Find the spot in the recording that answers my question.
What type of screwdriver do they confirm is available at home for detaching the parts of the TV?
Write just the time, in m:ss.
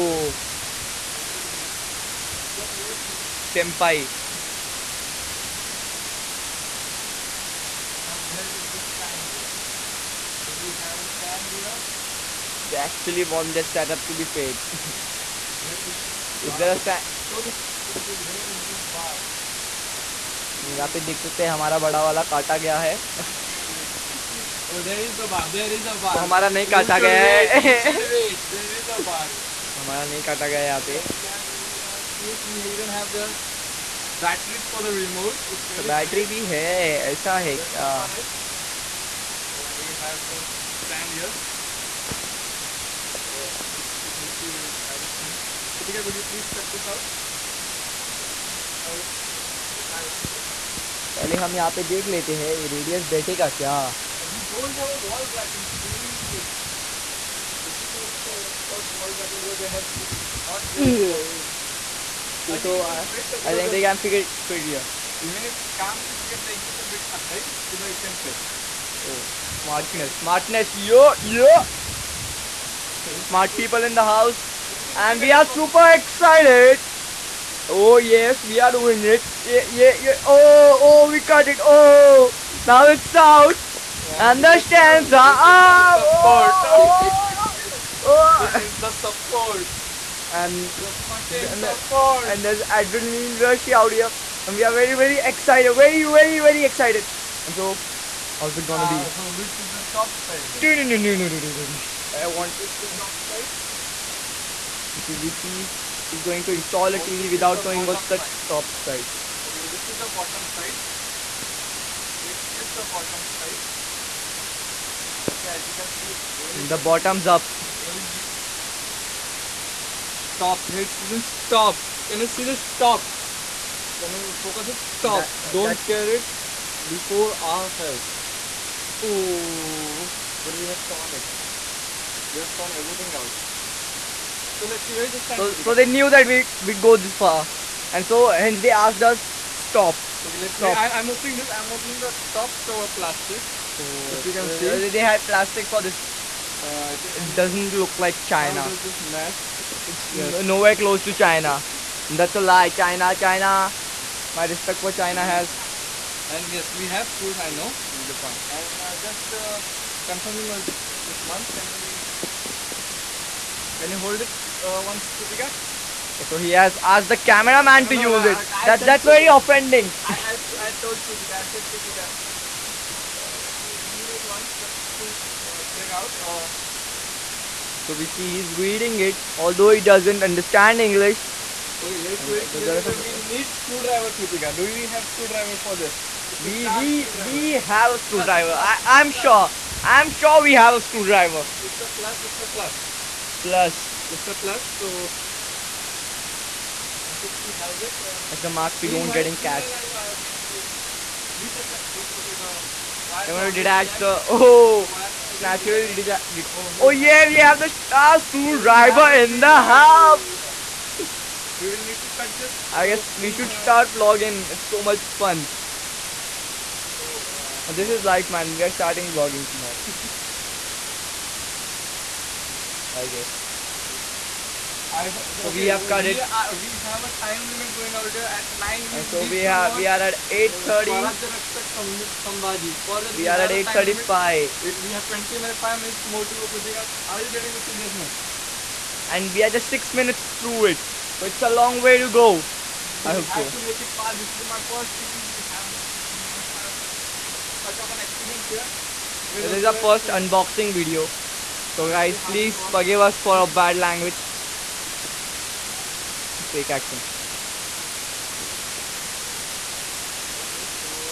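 3:27.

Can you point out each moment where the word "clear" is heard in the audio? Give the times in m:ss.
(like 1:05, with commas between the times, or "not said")
3:02.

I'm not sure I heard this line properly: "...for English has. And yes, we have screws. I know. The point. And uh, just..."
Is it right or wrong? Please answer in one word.
wrong.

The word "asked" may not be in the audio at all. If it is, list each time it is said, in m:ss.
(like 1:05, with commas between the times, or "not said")
2:18, 2:46.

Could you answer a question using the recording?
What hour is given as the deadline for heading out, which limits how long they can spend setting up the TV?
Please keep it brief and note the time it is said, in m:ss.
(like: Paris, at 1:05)
9, at 3:48.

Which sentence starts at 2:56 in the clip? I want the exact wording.
Uh, so we see he's reading it, although he doesn't understand English.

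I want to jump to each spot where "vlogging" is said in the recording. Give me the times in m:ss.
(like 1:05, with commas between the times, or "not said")
3:33, 3:39.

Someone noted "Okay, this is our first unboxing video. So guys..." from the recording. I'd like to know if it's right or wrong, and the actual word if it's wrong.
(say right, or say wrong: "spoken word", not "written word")
right.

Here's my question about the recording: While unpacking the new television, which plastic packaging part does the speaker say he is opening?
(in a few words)
top cover.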